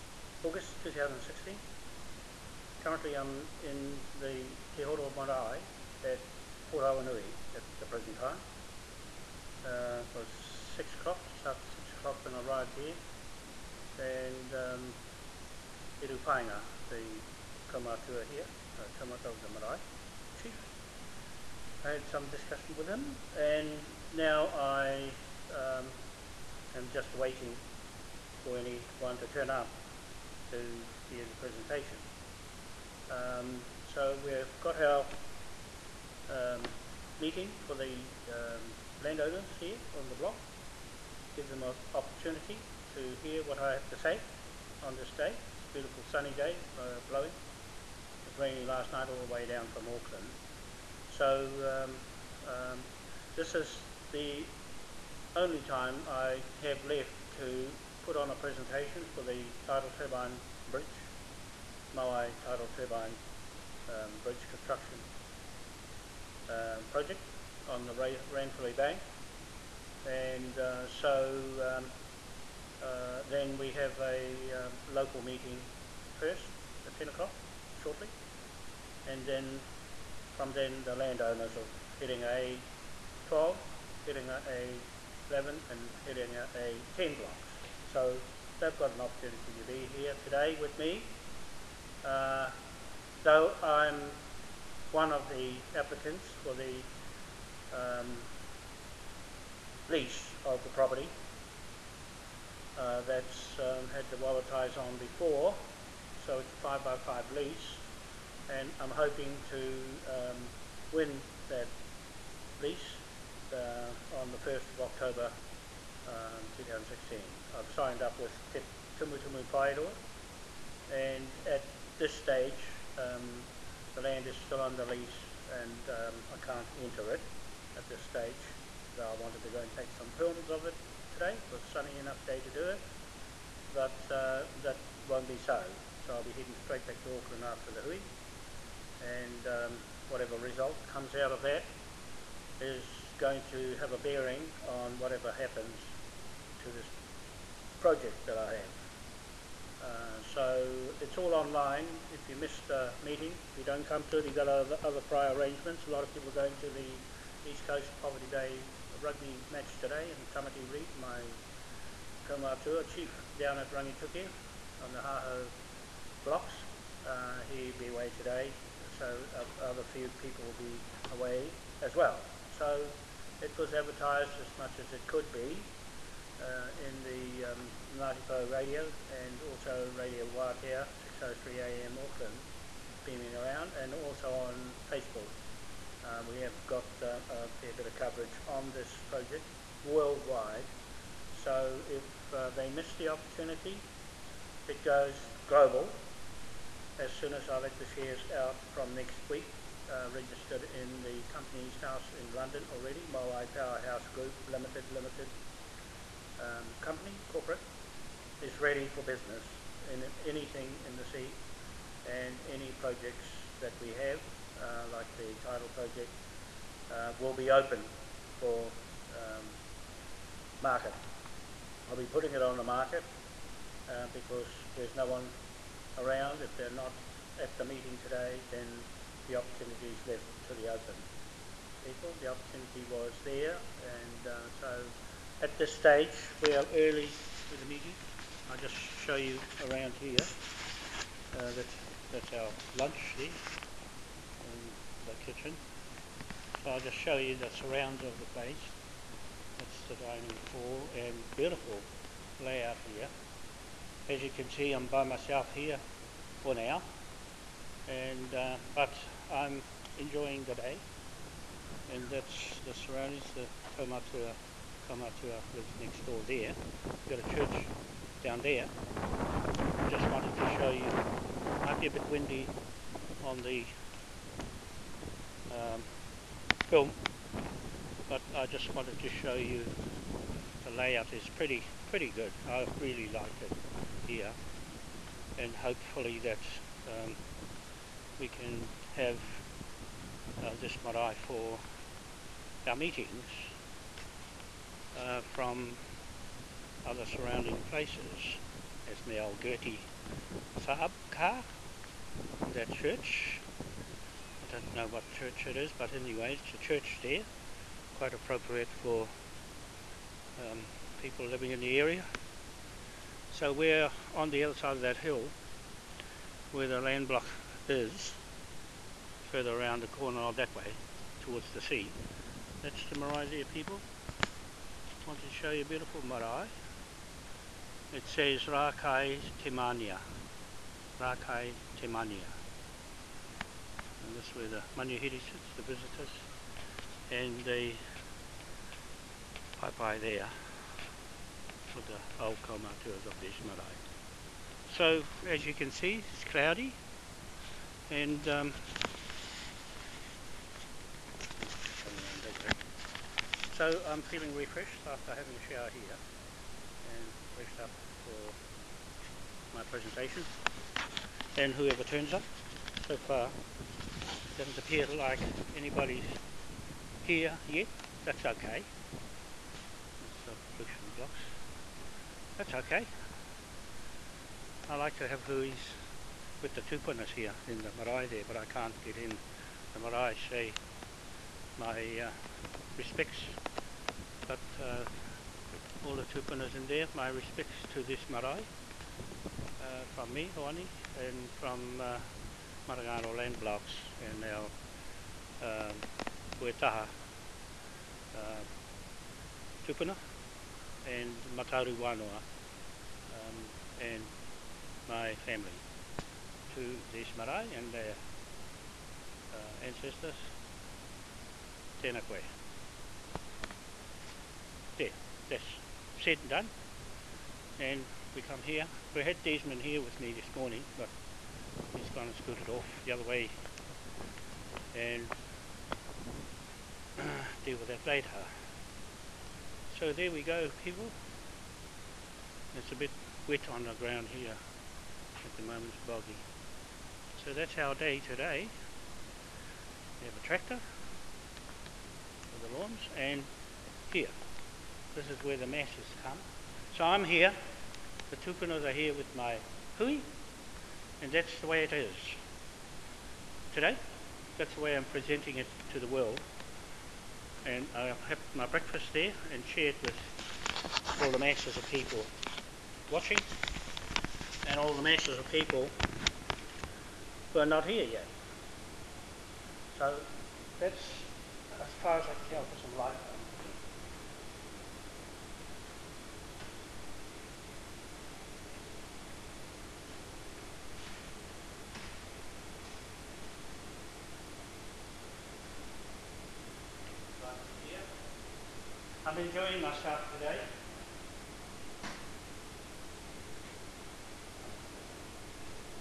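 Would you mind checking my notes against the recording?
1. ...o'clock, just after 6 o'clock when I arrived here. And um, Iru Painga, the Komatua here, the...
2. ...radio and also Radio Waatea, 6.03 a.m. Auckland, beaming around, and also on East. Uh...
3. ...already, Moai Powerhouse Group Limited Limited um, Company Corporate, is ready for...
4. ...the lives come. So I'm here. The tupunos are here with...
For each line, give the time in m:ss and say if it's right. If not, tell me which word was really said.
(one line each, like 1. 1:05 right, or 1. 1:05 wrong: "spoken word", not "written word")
1. 0:10 right
2. 2:58 wrong: "Facebook", not "East"
3. 3:22 right
4. 7:25 wrong: "masses", not "lives".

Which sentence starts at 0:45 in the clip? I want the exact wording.
It's a beautiful sunny day, it's uh, blowing.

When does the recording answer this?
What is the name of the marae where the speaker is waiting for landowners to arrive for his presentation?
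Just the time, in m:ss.
0:04.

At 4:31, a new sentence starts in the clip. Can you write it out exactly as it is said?
Might be a bit windy on the um, film, but I just wanted to show you the layout is pretty pretty good.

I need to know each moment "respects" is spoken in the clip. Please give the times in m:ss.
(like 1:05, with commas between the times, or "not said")
6:22, 6:27.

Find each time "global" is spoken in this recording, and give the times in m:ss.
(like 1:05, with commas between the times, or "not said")
3:15.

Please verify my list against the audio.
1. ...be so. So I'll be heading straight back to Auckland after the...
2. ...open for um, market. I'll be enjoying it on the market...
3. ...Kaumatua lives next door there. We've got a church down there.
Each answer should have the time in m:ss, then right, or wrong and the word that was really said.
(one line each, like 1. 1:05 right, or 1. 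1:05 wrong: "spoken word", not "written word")
1. 2:15 right
2. 3:37 wrong: "putting", not "enjoying"
3. 4:24 right.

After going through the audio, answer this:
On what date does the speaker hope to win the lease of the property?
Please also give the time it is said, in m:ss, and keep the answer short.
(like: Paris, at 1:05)
1 October 2016, at 1:54.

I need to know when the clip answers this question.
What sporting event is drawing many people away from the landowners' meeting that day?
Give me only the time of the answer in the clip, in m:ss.
2:37.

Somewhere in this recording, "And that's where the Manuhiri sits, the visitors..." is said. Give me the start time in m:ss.
5:34.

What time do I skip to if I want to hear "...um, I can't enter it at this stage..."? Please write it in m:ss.
2:05.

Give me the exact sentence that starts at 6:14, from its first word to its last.
I like to have hui's with the tūpunas here in the marae there, but I can't get in.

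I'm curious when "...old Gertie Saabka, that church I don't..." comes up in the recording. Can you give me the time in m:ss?
4:59.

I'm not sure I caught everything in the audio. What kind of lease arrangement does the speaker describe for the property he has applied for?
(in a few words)
5 by 5.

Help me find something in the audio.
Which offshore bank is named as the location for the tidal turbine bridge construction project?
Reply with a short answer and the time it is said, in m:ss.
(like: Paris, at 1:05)
Ranfurly Bank, at 1:07.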